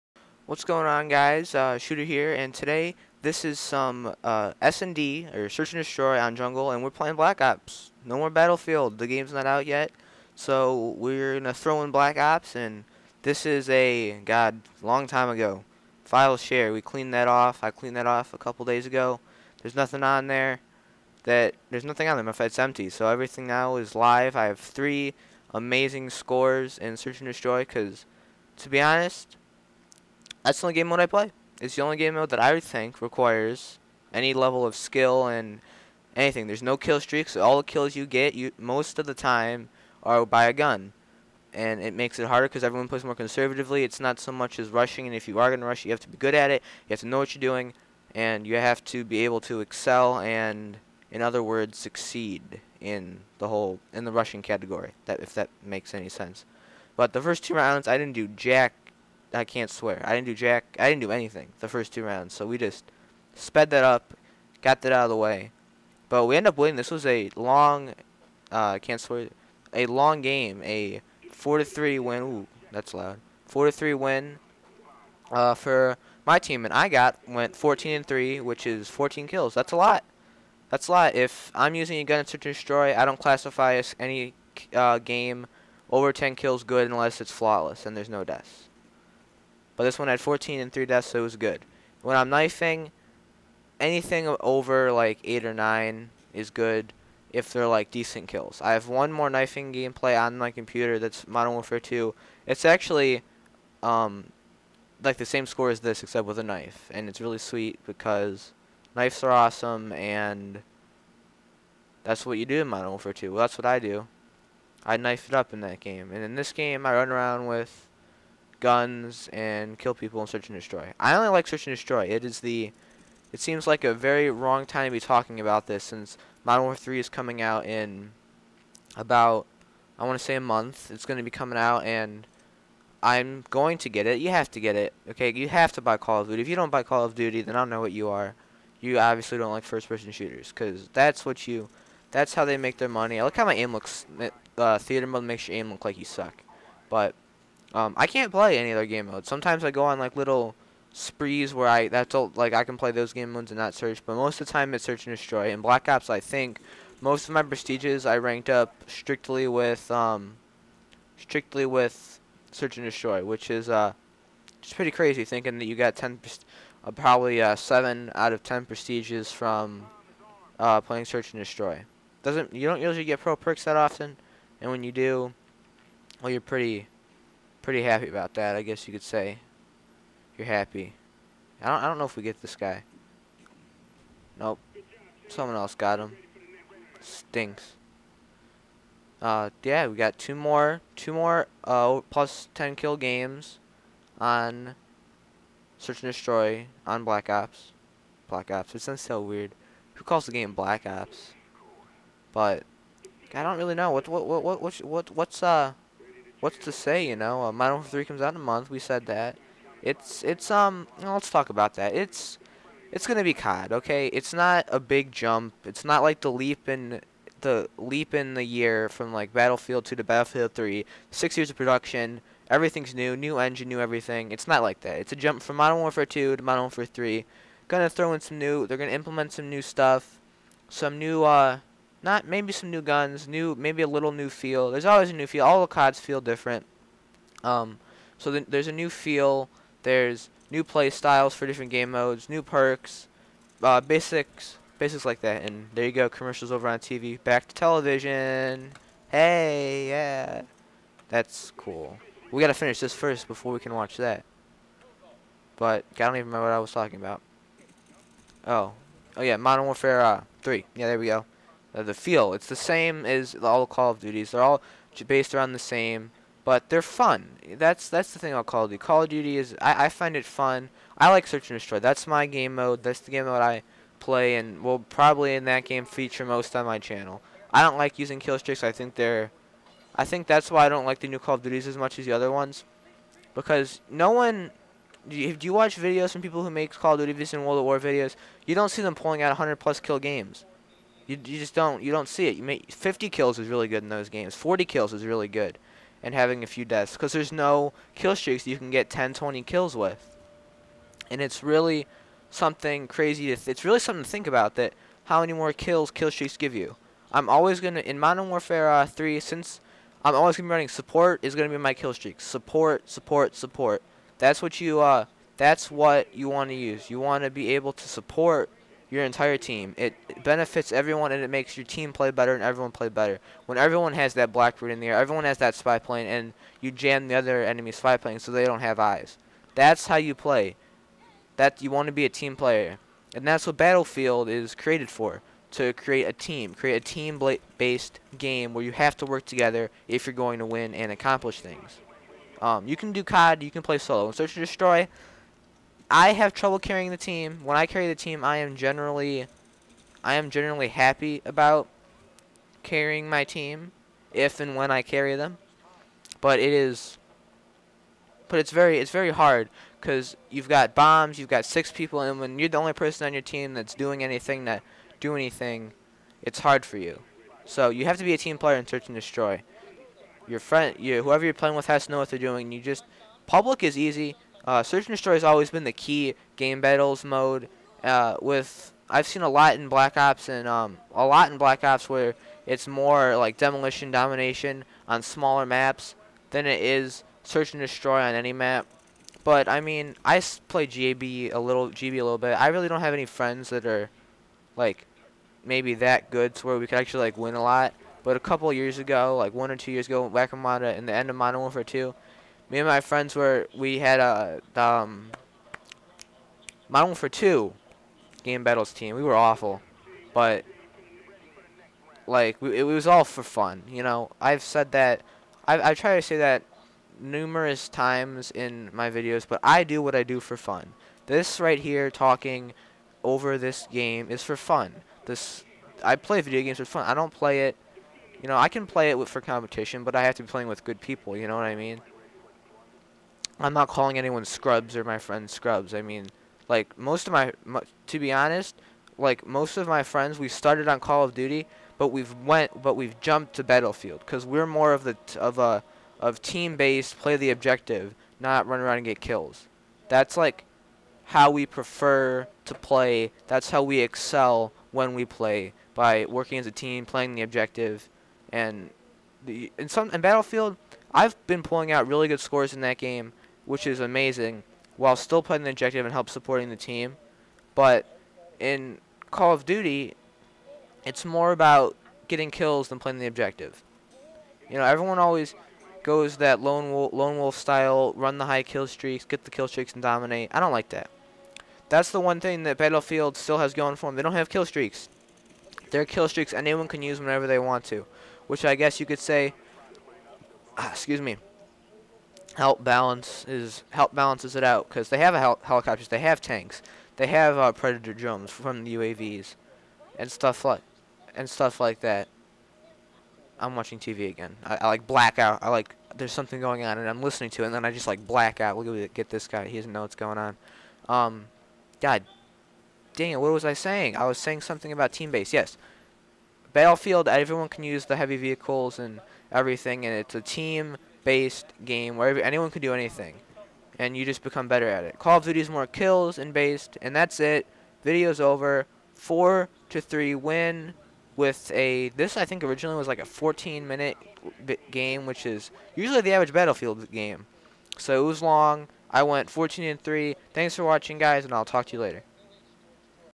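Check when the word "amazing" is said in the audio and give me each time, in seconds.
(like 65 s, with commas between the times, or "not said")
25 s, 463 s.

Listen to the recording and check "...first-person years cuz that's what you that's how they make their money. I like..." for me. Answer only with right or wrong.
wrong.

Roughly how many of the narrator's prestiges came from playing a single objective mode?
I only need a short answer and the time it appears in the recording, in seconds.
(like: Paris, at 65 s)
7, at 167 s.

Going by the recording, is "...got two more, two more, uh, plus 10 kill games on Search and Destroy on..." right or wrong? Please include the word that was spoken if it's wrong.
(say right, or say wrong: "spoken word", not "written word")
right.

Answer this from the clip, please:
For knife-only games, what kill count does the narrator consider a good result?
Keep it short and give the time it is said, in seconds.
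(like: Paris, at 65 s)
8 or 9, at 95 s.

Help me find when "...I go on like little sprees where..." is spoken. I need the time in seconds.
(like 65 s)
149 s.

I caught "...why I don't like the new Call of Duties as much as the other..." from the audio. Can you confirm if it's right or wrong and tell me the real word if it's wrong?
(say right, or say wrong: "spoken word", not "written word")
right.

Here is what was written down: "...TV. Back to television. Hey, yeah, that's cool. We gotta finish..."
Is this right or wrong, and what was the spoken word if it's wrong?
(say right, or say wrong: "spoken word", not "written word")
right.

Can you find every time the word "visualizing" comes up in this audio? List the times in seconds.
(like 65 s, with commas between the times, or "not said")
not said.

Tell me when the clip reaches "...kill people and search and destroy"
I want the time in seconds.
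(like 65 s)
119 s.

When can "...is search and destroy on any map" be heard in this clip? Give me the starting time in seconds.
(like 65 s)
386 s.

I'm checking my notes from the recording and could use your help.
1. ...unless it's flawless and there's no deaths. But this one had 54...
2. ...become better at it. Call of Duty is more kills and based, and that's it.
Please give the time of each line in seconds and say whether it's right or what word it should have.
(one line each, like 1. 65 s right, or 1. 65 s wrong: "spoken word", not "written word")
1. 86 s wrong: "14", not "54"
2. 524 s right.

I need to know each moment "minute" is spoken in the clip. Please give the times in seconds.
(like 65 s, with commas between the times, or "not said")
533 s.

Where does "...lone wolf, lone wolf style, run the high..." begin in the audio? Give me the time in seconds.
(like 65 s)
476 s.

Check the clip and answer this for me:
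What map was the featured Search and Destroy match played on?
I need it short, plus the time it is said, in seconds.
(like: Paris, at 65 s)
Jungle, at 6 s.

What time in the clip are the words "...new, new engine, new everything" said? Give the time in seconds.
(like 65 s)
222 s.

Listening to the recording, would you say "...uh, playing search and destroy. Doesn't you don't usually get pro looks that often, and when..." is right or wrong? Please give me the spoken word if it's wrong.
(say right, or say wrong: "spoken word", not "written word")
wrong: "perks", not "looks".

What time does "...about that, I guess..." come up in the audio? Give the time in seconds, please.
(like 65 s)
178 s.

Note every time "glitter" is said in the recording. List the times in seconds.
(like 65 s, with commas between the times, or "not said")
not said.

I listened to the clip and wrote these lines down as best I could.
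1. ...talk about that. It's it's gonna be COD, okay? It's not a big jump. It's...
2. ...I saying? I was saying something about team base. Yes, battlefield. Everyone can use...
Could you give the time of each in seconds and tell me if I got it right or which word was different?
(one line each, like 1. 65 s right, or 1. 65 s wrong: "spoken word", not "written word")
1. 211 s right
2. 513 s right.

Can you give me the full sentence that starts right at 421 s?
This right here, talking over this game, is for fun.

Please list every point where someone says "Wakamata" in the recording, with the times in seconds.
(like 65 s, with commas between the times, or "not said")
400 s.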